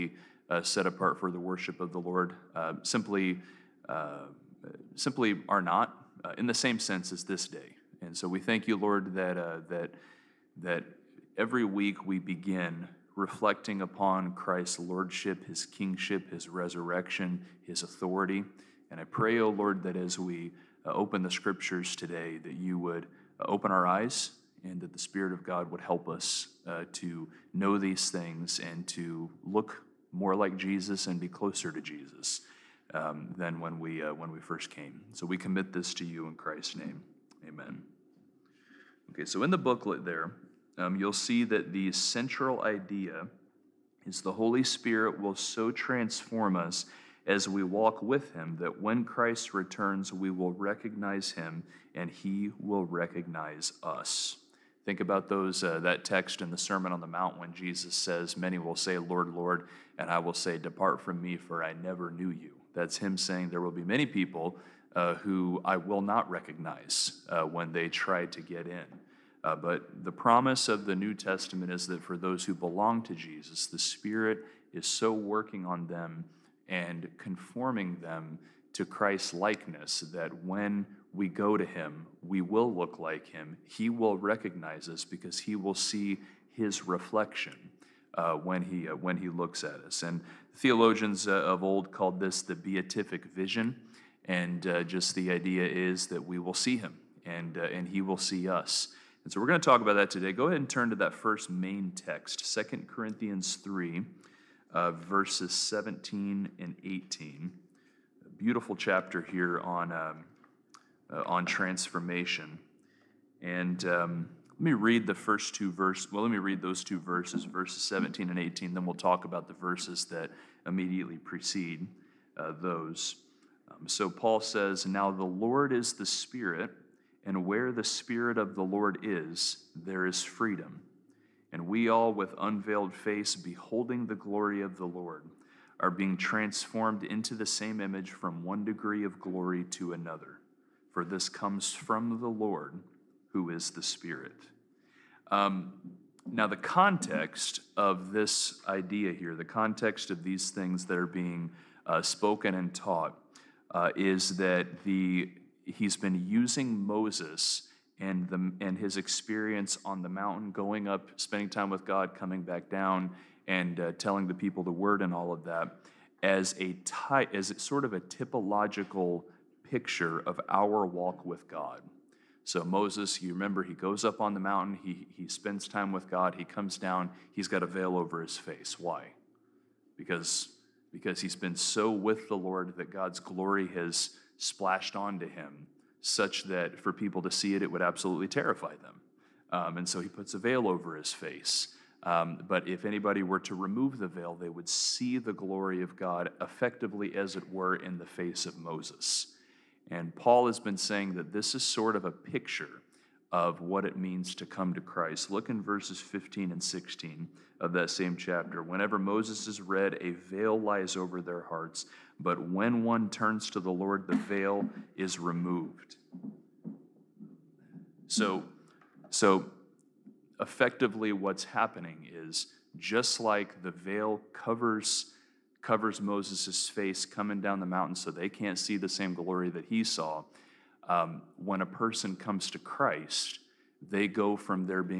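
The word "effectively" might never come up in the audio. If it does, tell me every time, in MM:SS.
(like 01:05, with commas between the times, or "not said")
03:16, 03:40.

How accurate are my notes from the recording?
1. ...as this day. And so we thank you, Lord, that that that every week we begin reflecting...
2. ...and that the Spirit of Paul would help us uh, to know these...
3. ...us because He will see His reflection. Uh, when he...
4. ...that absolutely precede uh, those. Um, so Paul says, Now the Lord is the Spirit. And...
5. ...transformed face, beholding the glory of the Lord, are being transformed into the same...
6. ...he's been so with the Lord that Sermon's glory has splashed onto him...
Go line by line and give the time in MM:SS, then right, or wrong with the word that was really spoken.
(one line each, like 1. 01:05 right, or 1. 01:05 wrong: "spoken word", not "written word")
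1. 00:07 right
2. 00:24 wrong: "God", not "Paul"
3. 01:24 right
4. 02:00 wrong: "immediately", not "absolutely"
5. 02:12 wrong: "unveiled", not "transformed"
6. 03:01 wrong: "God", not "Sermon".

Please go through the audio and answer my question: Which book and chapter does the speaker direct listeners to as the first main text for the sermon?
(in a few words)
2 Corinthians 3.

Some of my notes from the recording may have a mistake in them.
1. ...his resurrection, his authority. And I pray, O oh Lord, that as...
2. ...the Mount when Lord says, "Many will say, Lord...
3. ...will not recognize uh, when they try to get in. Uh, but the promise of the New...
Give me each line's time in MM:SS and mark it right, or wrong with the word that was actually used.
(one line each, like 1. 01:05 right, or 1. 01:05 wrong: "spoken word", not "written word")
1. 00:16 right
2. 00:57 wrong: "Jesus", not "Lord"
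3. 01:05 right.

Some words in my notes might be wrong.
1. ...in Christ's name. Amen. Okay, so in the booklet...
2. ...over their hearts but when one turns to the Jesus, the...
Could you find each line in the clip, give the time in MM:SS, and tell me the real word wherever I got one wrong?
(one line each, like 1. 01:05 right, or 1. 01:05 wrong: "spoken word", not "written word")
1. 00:36 right
2. 03:30 wrong: "Lord", not "Jesus".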